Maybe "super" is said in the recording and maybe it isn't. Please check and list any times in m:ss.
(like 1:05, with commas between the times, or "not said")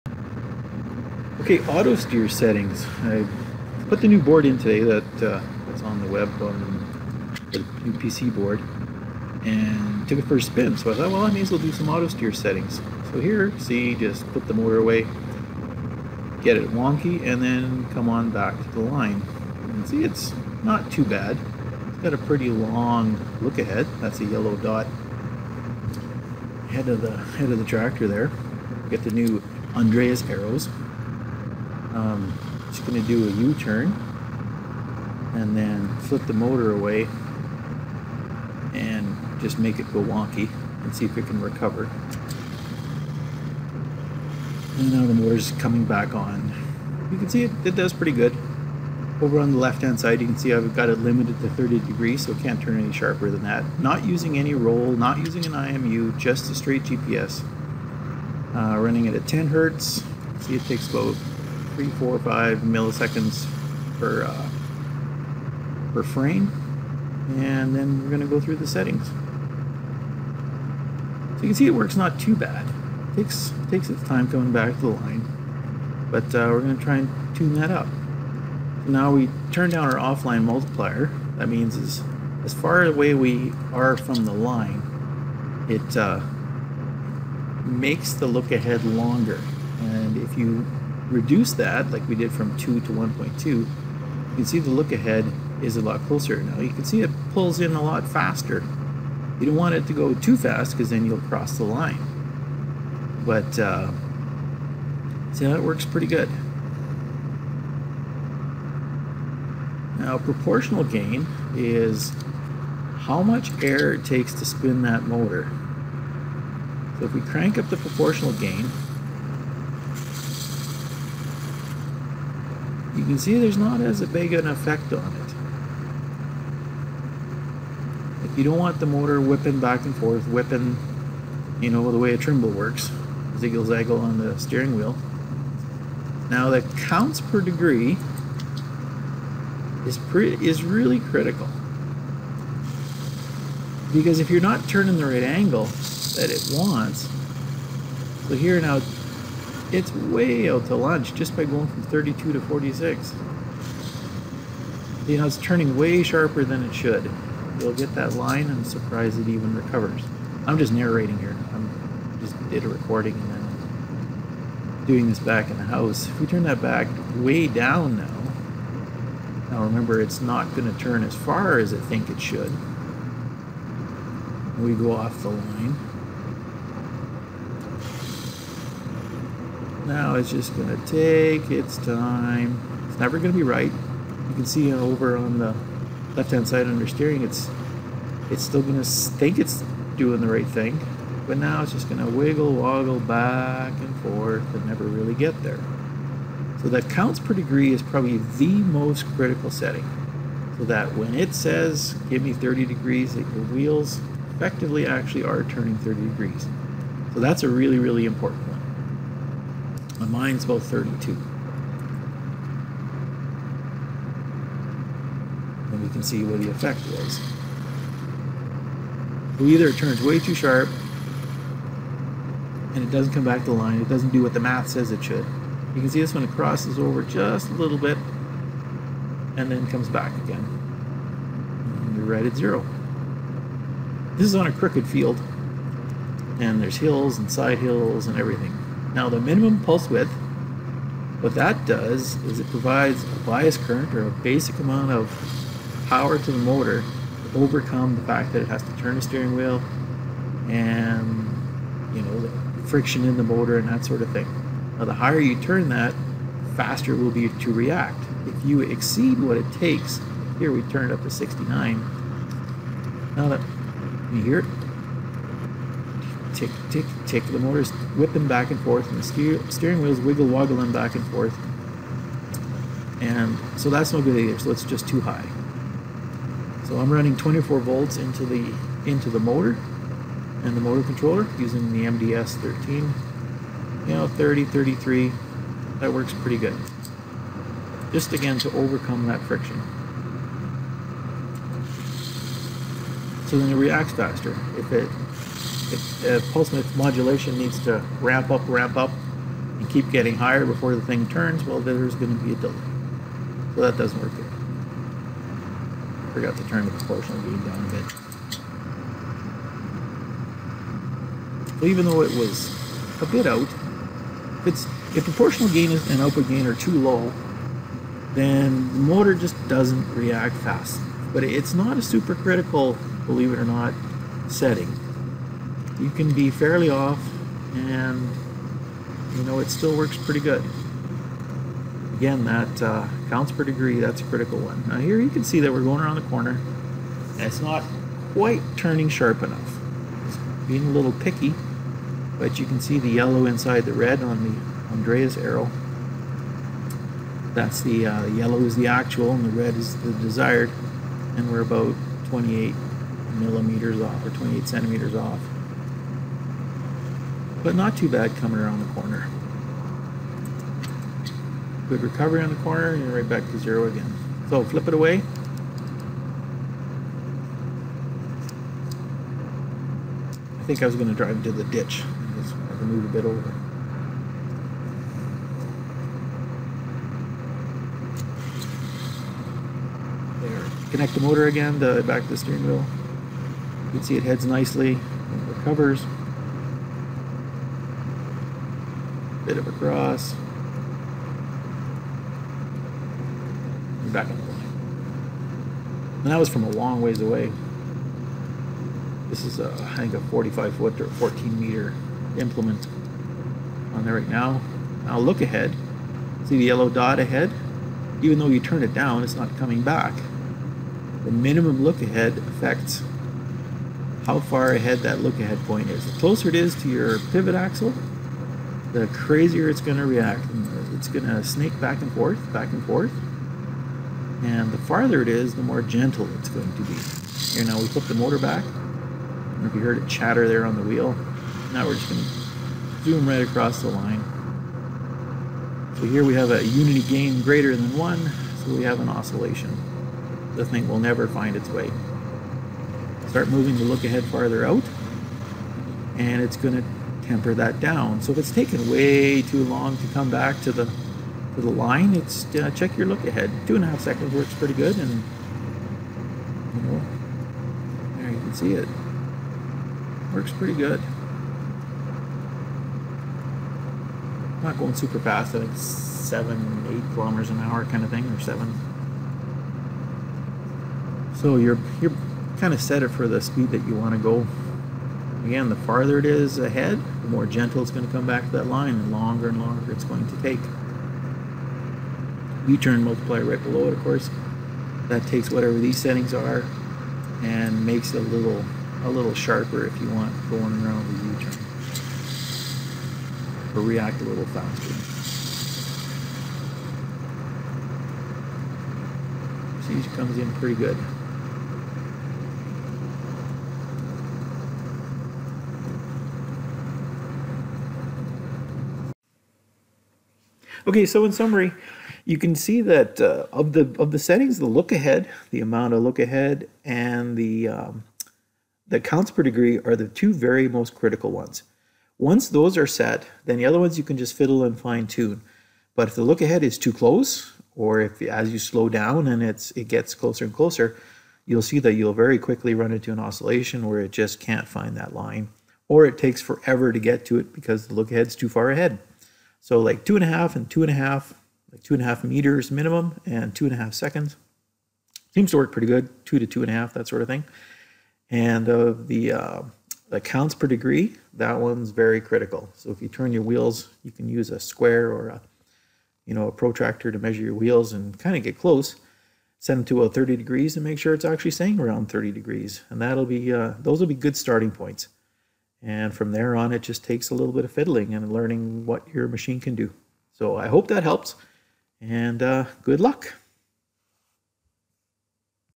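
5:21, 7:44.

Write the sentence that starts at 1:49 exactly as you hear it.
Now proportional gain is how much air it takes to spin that motor.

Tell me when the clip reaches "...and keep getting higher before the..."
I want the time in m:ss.
4:59.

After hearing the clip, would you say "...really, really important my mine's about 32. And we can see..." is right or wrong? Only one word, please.
right.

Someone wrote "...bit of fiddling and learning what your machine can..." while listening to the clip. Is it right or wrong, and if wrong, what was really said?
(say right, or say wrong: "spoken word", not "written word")
right.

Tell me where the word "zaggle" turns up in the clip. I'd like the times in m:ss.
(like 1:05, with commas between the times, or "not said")
2:13.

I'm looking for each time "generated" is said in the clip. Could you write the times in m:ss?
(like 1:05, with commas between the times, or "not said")
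not said.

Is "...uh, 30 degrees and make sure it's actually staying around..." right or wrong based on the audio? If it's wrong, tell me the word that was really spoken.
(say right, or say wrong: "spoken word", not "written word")
right.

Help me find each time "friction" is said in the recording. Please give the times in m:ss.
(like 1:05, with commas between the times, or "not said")
4:12, 4:49.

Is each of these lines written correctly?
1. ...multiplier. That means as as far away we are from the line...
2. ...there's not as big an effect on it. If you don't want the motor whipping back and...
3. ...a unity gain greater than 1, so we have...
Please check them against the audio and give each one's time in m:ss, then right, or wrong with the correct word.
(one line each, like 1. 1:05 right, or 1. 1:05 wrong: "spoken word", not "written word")
1. 1:20 right
2. 2:03 right
3. 7:16 right.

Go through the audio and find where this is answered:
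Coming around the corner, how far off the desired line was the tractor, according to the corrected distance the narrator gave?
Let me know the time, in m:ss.
5:54.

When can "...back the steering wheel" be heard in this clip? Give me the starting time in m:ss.
6:21.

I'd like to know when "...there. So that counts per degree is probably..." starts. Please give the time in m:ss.
3:15.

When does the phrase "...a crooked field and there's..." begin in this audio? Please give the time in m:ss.
3:54.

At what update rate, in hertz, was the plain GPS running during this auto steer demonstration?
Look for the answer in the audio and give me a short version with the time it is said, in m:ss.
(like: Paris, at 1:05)
10 hertz, at 0:59.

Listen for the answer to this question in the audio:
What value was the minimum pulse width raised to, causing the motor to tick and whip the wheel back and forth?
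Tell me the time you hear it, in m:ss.
4:21.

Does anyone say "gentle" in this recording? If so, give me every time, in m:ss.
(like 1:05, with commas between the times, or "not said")
7:05, 7:57.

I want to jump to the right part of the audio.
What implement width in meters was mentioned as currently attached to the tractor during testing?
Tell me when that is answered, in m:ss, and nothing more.
6:40.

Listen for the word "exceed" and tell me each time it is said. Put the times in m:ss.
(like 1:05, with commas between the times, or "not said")
4:18.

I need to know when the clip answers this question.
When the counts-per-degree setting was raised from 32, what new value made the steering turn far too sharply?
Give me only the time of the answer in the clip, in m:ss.
2:32.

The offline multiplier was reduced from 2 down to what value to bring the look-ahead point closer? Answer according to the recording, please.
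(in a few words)
1.2.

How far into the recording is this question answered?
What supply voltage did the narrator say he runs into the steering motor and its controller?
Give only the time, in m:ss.
4:37.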